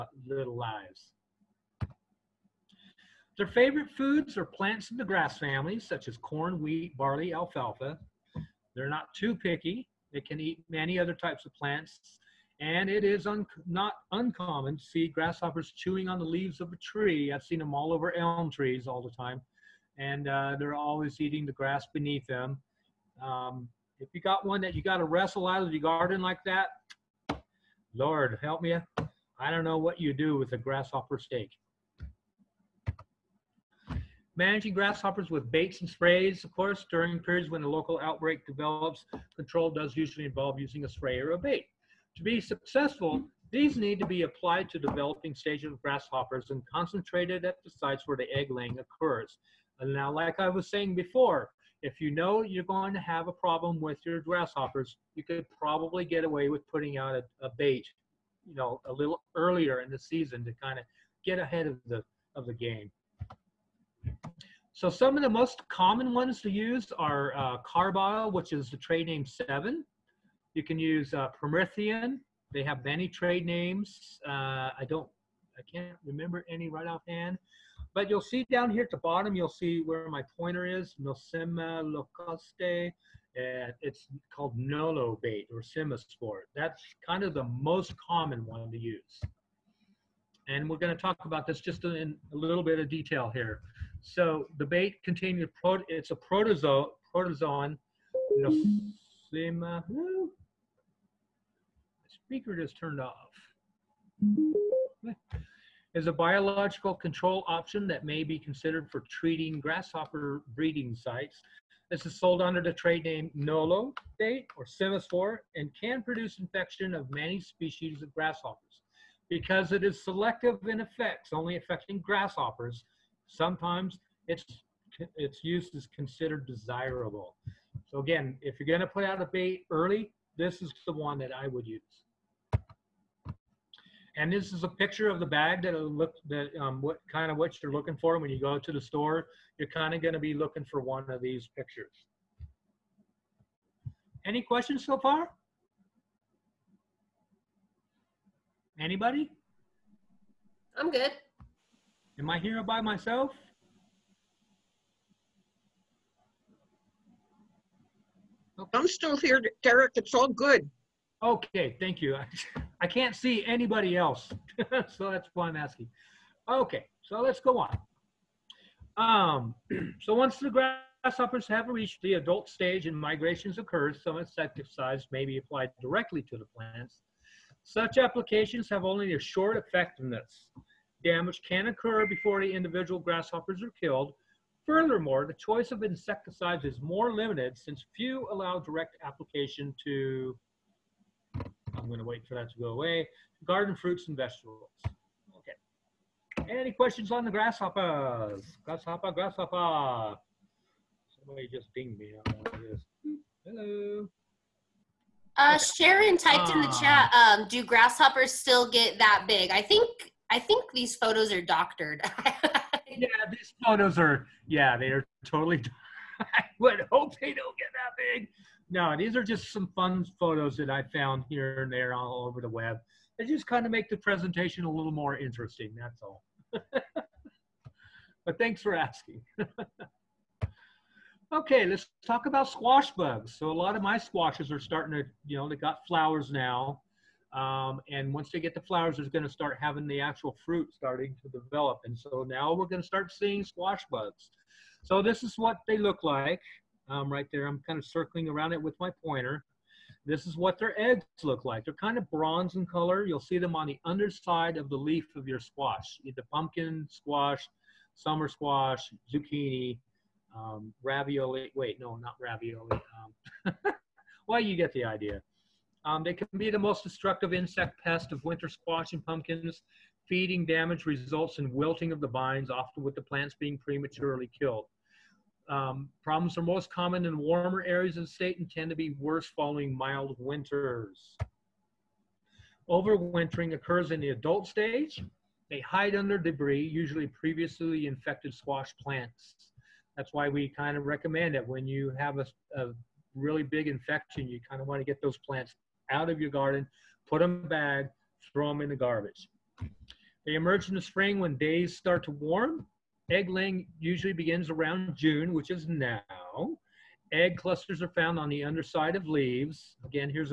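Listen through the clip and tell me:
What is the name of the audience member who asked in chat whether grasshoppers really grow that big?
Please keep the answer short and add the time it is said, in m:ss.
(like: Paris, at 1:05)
Sharon, at 3:25.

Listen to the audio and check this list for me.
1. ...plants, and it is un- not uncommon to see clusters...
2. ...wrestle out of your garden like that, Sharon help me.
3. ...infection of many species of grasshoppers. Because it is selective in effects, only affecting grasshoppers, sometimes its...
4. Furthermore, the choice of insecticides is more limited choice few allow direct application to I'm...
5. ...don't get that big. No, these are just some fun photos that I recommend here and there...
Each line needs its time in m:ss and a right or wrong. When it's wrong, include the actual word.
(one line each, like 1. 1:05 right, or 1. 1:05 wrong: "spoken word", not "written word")
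1. 0:11 wrong: "grasshoppers", not "clusters"
2. 0:25 wrong: "Lord", not "Sharon"
3. 1:56 right
4. 3:04 wrong: "since", not "choice"
5. 3:37 wrong: "found", not "recommend".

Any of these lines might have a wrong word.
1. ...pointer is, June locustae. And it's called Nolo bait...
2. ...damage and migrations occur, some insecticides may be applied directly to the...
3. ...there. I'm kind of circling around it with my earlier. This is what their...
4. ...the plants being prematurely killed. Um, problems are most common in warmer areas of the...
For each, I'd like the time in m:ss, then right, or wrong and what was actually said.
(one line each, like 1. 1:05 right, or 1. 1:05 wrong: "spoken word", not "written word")
1. 1:20 wrong: "Nosema", not "June"
2. 2:52 wrong: "stage", not "damage"
3. 4:07 wrong: "pointer", not "earlier"
4. 4:32 right.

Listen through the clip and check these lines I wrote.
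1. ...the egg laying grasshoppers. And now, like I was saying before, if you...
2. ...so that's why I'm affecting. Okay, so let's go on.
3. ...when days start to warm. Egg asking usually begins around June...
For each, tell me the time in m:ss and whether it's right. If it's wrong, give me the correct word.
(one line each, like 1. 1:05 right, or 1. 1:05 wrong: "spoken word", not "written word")
1. 0:48 wrong: "occurs", not "grasshoppers"
2. 2:44 wrong: "asking", not "affecting"
3. 5:01 wrong: "laying", not "asking".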